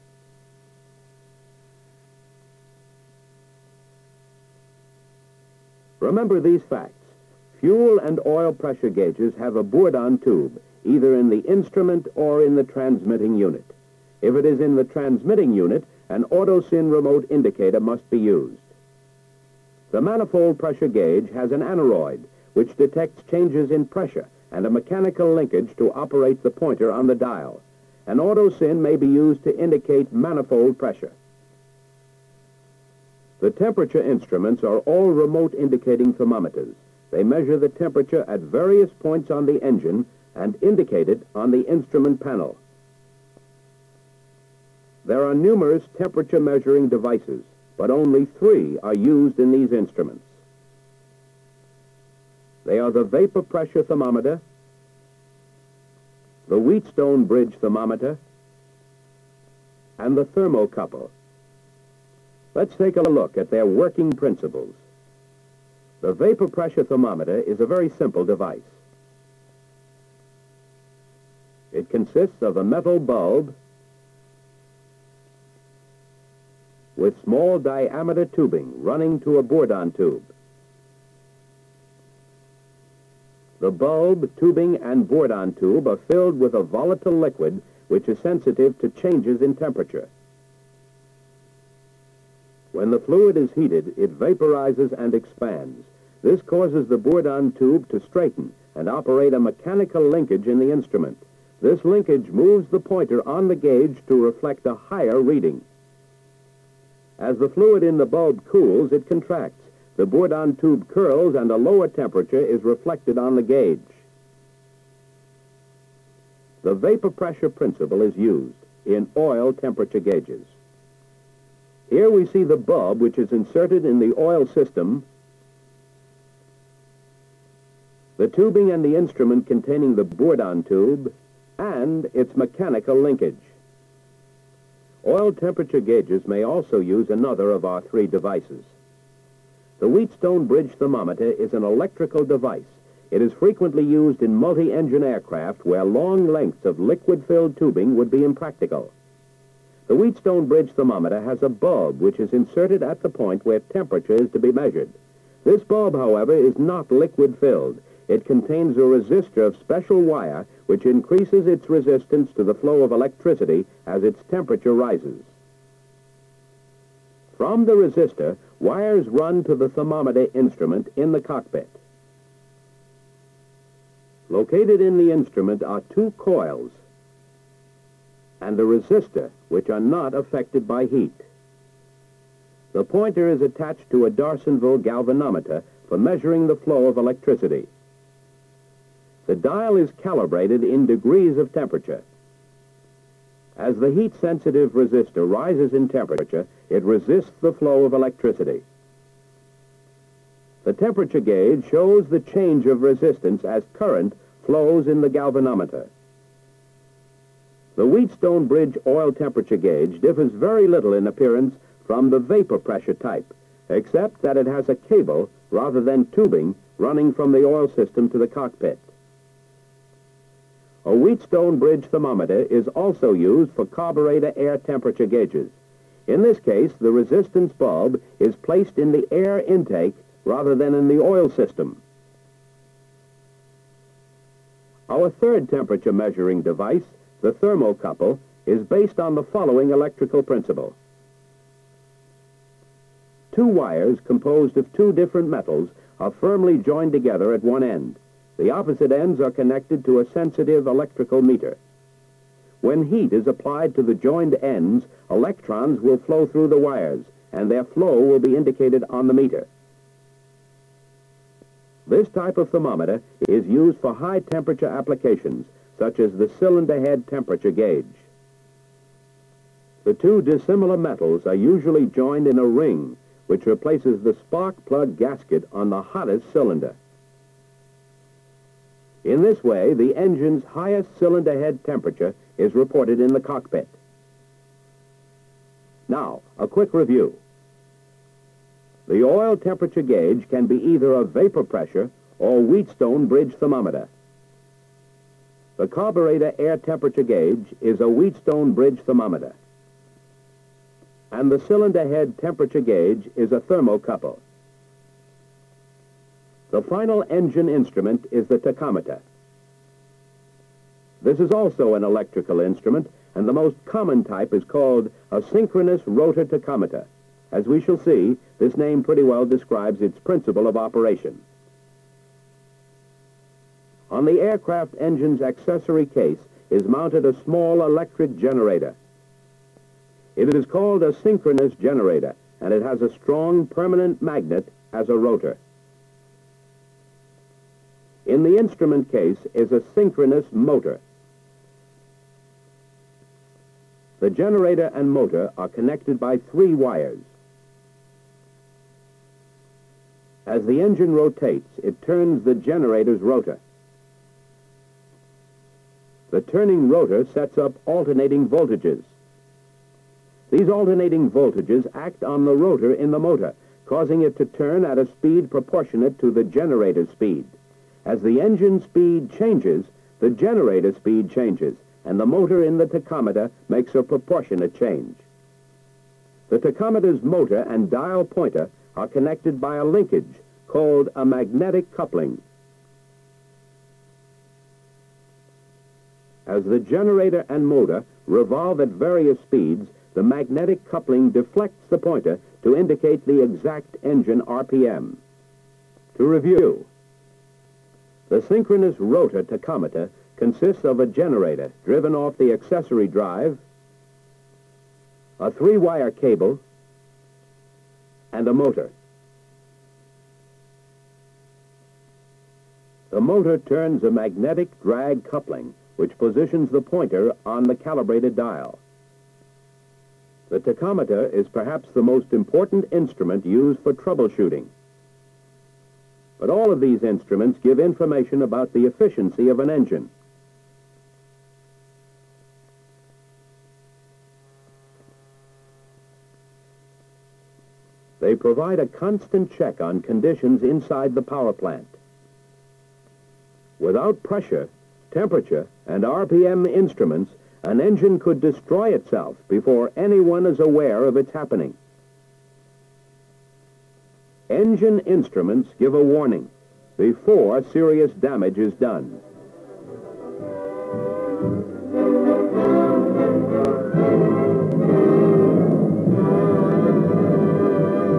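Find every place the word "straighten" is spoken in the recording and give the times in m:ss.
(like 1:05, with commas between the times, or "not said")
1:37.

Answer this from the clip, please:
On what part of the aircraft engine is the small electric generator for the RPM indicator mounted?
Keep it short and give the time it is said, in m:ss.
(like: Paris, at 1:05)
accessory case, at 5:25.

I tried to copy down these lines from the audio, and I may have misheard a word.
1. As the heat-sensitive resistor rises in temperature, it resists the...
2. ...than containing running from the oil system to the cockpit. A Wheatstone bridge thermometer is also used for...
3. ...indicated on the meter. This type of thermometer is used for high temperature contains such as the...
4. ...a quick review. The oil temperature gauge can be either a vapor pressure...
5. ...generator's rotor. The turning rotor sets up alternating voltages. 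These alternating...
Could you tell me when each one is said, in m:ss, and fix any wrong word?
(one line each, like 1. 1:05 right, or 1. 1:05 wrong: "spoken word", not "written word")
1. 3:13 right
2. 3:35 wrong: "tubing", not "containing"
3. 4:18 wrong: "applications", not "contains"
4. 4:46 right
5. 5:52 right.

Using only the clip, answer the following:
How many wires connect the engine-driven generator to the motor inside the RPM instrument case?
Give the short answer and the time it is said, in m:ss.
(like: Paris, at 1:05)
3, at 5:46.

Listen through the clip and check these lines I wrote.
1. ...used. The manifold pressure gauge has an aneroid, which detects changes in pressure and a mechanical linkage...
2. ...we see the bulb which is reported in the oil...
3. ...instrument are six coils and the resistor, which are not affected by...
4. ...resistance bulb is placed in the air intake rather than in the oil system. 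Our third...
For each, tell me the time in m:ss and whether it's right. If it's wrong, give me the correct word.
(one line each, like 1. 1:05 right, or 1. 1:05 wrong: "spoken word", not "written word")
1. 0:18 right
2. 2:02 wrong: "inserted", not "reported"
3. 2:55 wrong: "two", not "six"
4. 3:46 right.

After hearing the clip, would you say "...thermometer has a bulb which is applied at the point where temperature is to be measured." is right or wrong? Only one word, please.
wrong.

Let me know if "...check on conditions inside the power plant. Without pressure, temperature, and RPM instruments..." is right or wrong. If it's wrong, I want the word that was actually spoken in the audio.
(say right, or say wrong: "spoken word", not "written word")
right.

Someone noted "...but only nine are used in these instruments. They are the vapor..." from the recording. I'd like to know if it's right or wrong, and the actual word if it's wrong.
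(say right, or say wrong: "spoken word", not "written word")
wrong: "three", not "nine".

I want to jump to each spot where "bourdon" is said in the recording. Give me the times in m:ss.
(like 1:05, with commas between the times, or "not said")
0:09, 1:19, 1:25, 1:36, 1:50, 2:10.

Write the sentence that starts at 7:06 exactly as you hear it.
But all of these instruments give information about the efficiency of an engine.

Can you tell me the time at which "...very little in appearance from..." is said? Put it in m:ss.
3:30.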